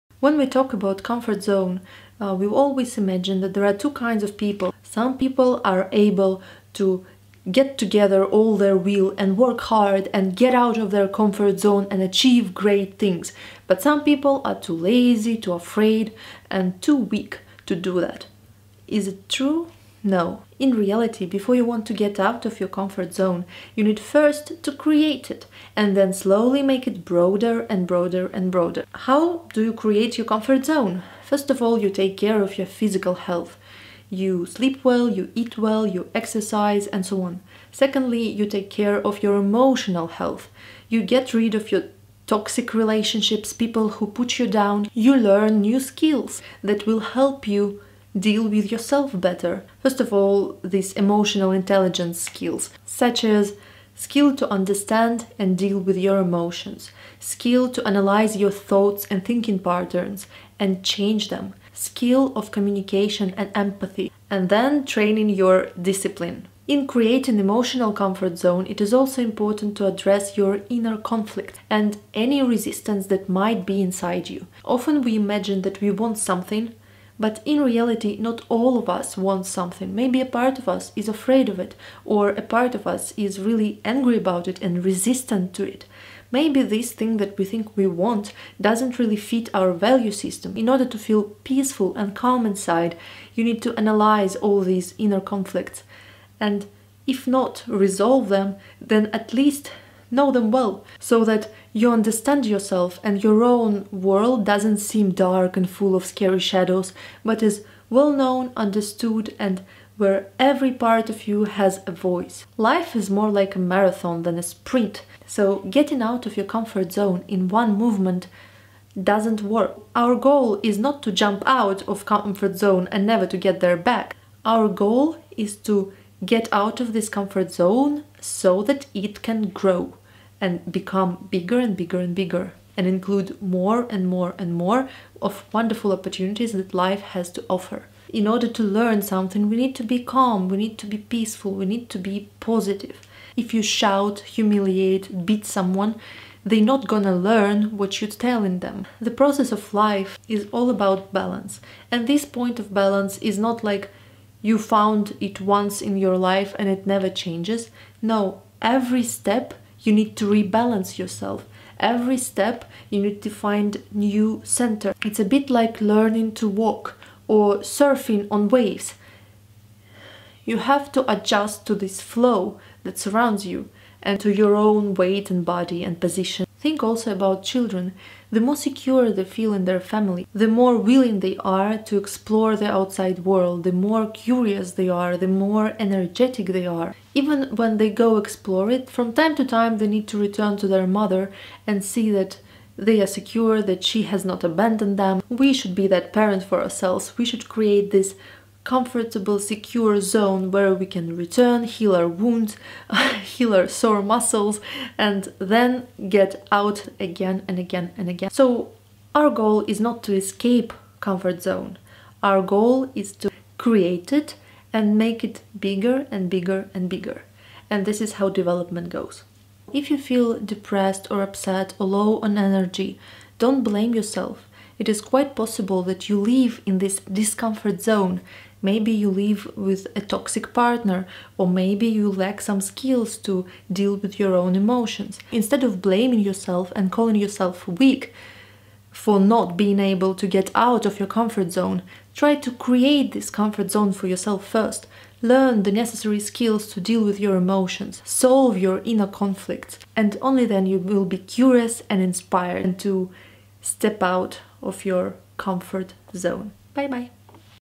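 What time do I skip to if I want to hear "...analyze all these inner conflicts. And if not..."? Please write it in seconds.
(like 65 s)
93 s.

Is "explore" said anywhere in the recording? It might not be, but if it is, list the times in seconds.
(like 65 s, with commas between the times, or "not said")
181 s, 188 s.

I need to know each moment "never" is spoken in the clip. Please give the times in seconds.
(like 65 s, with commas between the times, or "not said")
123 s, 156 s.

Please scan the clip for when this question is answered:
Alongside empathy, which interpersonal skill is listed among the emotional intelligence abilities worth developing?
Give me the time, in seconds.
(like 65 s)
62 s.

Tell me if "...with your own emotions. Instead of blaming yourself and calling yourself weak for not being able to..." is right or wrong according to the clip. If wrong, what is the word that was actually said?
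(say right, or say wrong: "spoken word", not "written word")
right.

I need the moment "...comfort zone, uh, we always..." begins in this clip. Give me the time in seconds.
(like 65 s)
1 s.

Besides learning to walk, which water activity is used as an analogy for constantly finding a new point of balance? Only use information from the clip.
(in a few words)
surfing on waves.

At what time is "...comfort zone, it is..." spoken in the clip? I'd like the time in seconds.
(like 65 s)
67 s.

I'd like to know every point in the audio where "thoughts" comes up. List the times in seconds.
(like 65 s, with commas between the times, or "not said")
58 s.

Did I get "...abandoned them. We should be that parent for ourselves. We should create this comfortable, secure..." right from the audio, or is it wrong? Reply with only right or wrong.
right.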